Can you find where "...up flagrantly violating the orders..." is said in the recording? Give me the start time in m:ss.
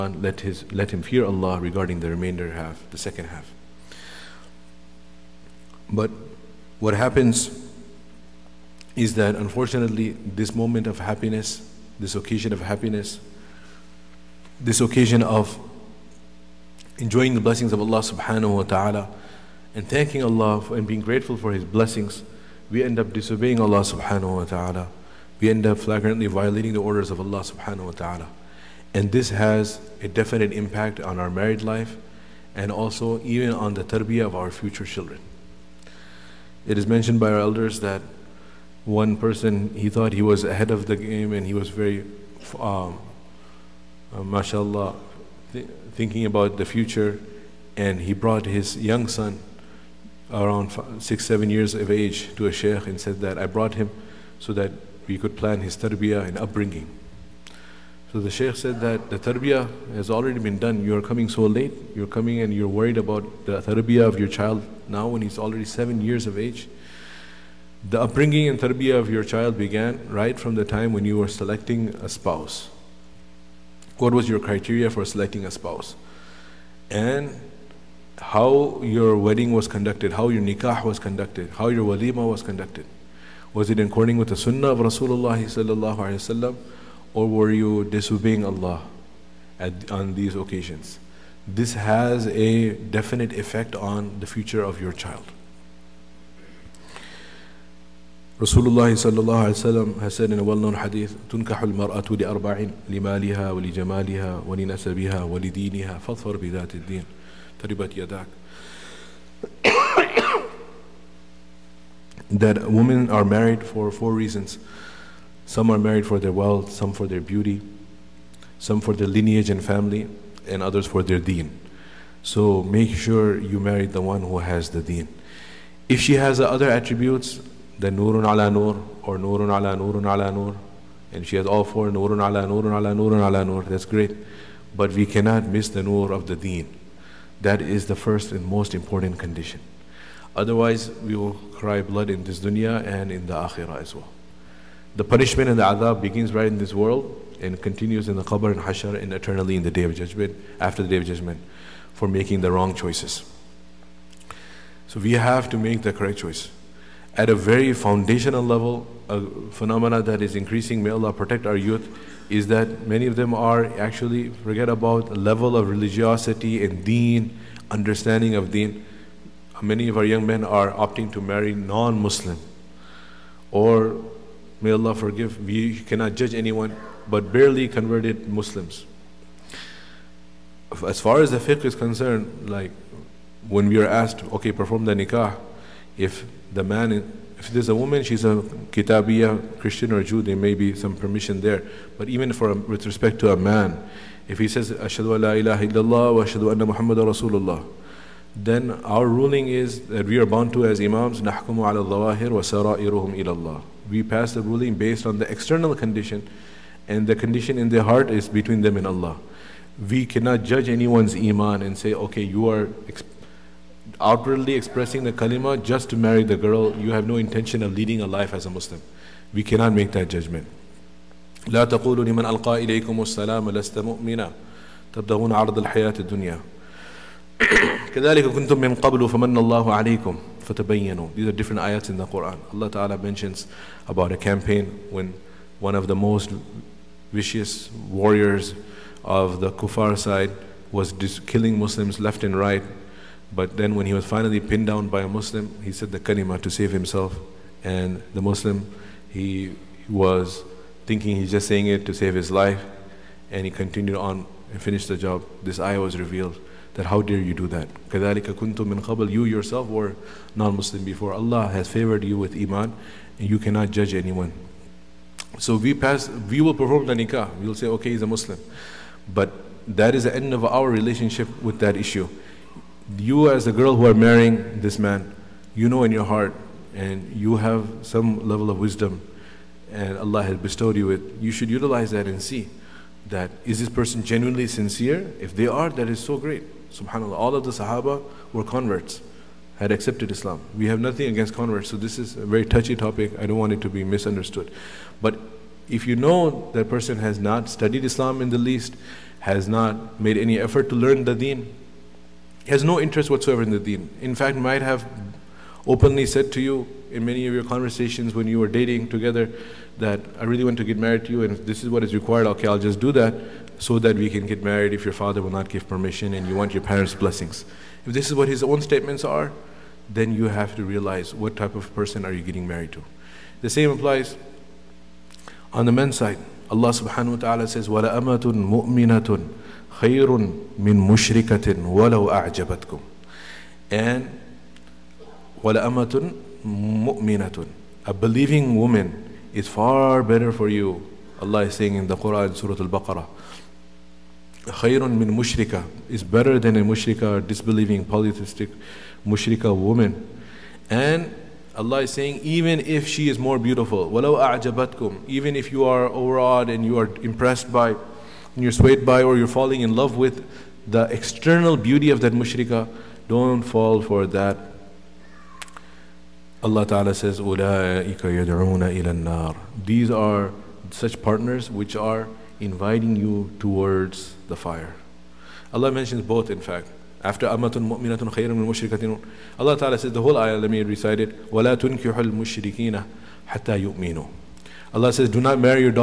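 0:25.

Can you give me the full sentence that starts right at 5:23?
The same applies on the men's side.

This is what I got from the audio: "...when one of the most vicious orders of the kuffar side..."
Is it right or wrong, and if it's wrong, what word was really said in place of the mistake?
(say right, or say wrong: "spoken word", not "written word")
wrong: "warriors", not "orders".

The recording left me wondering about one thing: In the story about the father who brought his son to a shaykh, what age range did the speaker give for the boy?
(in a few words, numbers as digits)
5 to 7 years.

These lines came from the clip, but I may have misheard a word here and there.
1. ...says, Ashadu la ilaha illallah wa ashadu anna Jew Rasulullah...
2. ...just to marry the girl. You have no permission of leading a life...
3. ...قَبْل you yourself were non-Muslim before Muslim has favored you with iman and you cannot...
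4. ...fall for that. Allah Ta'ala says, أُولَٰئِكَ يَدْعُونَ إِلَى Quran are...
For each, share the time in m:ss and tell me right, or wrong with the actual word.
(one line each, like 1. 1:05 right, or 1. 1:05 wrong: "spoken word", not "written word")
1. 3:14 wrong: "Muhammadan", not "Jew"
2. 3:35 wrong: "intention", not "permission"
3. 4:18 wrong: "Allah", not "Muslim"
4. 6:03 wrong: "These", not "Quran".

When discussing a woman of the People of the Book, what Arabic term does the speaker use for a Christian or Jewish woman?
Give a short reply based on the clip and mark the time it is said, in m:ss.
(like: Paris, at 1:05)
Kitabiya, at 3:08.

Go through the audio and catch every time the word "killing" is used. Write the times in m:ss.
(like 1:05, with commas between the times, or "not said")
4:01.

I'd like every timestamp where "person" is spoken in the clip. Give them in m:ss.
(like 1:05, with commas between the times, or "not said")
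0:39, 4:43, 4:56, 5:21.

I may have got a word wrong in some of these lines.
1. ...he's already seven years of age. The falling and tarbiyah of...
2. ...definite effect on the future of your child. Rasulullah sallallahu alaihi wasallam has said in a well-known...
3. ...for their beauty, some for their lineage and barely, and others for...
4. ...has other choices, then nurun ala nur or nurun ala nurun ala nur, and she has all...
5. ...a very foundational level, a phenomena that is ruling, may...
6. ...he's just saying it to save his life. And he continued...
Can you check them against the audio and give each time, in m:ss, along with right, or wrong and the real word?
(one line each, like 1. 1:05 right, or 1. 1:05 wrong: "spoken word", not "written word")
1. 1:05 wrong: "upbringing", not "falling"
2. 1:32 right
3. 1:56 wrong: "family", not "barely"
4. 2:06 wrong: "attributes", not "choices"
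5. 2:37 wrong: "increasing", not "ruling"
6. 4:11 right.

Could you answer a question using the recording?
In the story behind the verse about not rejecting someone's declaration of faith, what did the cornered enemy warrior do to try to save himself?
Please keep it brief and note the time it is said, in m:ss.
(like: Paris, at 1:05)
Said the kalima, at 4:05.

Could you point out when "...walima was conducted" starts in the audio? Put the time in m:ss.
1:21.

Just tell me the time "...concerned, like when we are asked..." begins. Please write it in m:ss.
3:01.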